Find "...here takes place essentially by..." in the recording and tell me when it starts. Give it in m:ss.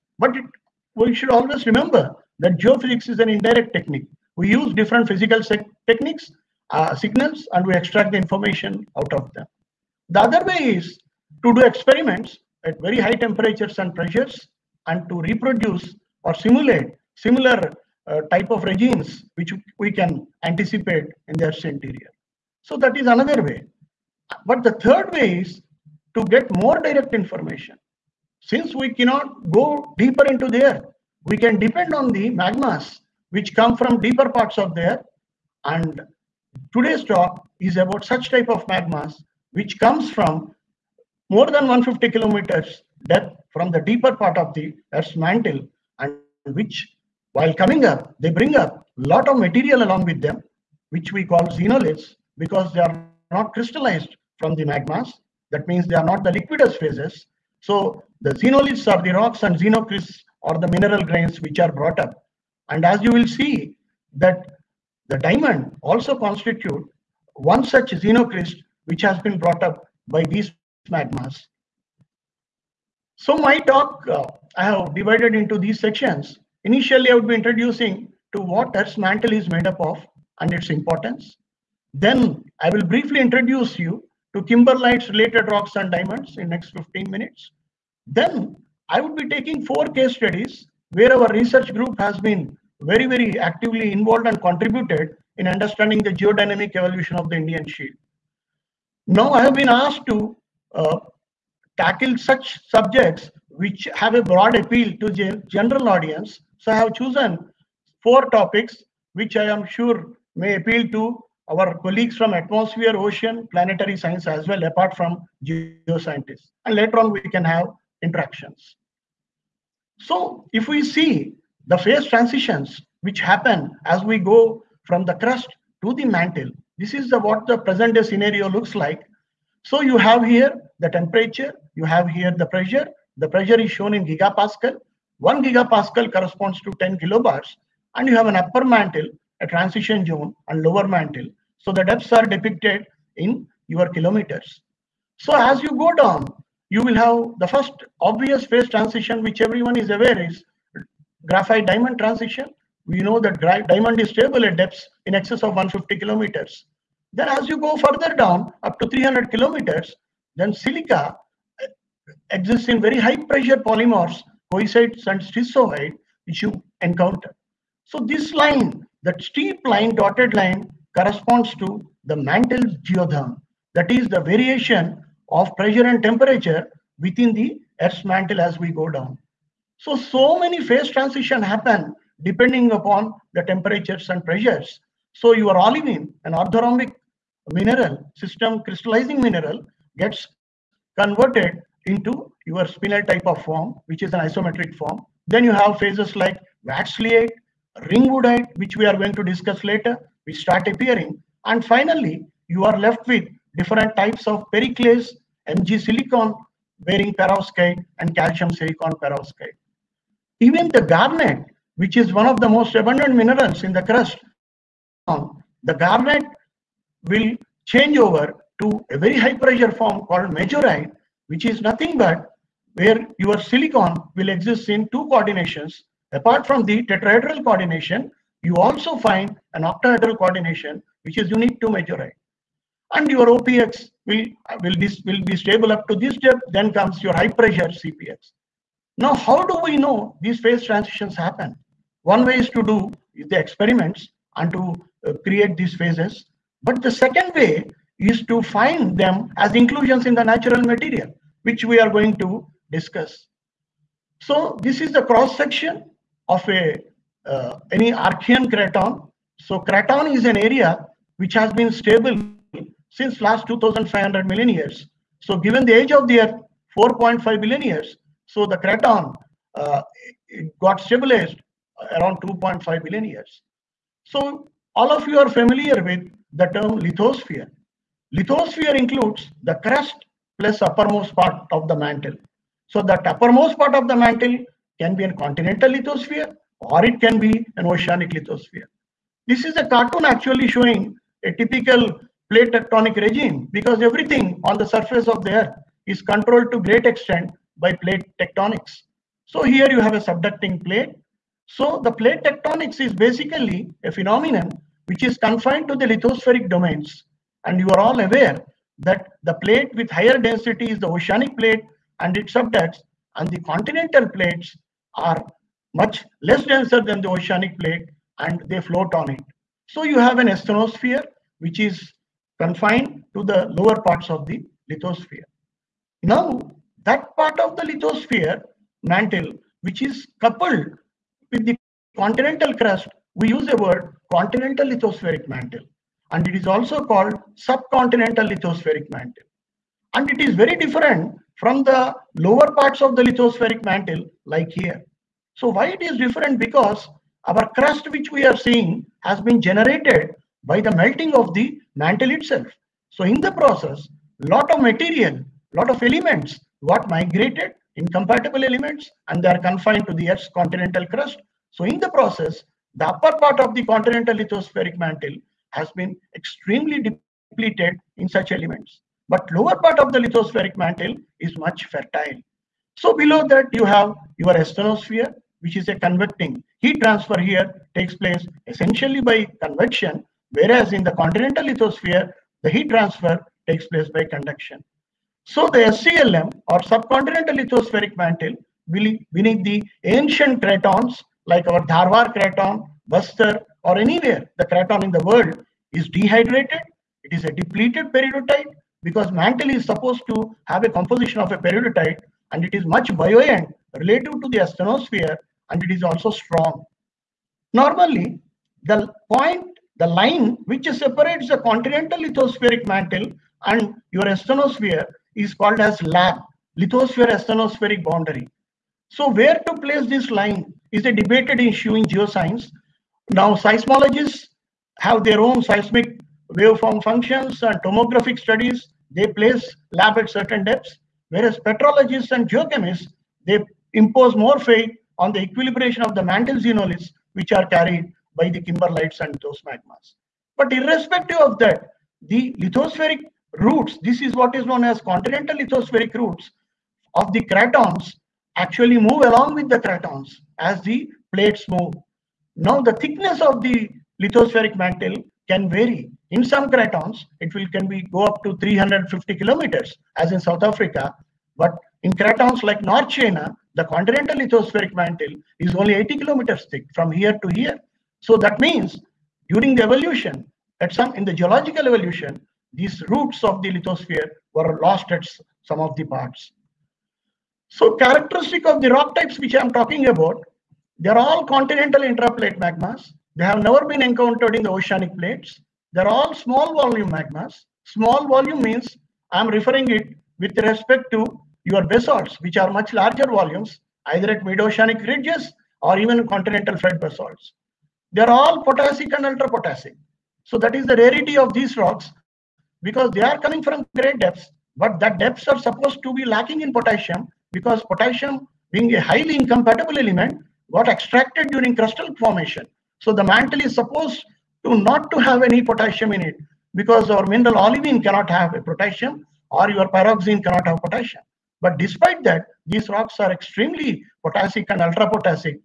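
6:17.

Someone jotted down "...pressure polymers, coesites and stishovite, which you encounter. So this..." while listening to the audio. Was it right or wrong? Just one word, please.
right.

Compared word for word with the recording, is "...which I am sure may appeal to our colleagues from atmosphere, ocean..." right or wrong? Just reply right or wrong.
right.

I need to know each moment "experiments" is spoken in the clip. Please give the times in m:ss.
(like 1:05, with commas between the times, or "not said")
0:11, 4:03.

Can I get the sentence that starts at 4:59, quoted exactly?
So here you have a subducting plate.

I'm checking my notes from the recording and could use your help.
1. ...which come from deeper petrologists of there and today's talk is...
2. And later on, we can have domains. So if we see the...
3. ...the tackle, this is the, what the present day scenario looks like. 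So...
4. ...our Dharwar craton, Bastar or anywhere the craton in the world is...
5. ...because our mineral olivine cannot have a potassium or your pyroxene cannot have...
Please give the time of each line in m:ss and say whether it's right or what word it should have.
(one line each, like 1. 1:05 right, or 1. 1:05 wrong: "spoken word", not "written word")
1. 0:33 wrong: "parts", not "petrologists"
2. 1:56 wrong: "interactions", not "domains"
3. 2:05 wrong: "mantle", not "tackle"
4. 6:31 right
5. 8:36 right.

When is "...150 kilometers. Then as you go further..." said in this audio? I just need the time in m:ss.
2:35.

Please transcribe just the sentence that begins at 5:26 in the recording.
Now, that part of the lithosphere mantle, which is coupled with the continental crust, we use the word continental lithospheric mantle.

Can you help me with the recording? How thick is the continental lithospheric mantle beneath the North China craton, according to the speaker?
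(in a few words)
80 kilometers.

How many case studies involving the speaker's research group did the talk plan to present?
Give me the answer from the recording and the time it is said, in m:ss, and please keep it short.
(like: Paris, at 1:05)
4, at 1:29.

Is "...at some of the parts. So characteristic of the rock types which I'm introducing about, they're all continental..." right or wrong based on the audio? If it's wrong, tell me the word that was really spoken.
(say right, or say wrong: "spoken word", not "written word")
wrong: "talking", not "introducing".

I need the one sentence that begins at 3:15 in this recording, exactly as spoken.
Then you have phases like wadsleyite, ringwoodite, which we are going to discuss later, which start appearing.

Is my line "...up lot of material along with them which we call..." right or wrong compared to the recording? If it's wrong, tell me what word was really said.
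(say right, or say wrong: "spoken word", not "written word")
right.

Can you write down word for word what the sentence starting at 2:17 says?
And you have an upper mantle, a transition zone, and lower mantle.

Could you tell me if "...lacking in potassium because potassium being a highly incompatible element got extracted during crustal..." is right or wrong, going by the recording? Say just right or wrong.
right.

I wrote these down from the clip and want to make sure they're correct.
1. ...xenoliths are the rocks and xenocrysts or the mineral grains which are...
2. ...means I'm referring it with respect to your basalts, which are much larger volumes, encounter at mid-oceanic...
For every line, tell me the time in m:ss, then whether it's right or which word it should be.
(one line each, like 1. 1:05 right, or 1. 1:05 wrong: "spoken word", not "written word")
1. 0:58 right
2. 8:08 wrong: "either", not "encounter".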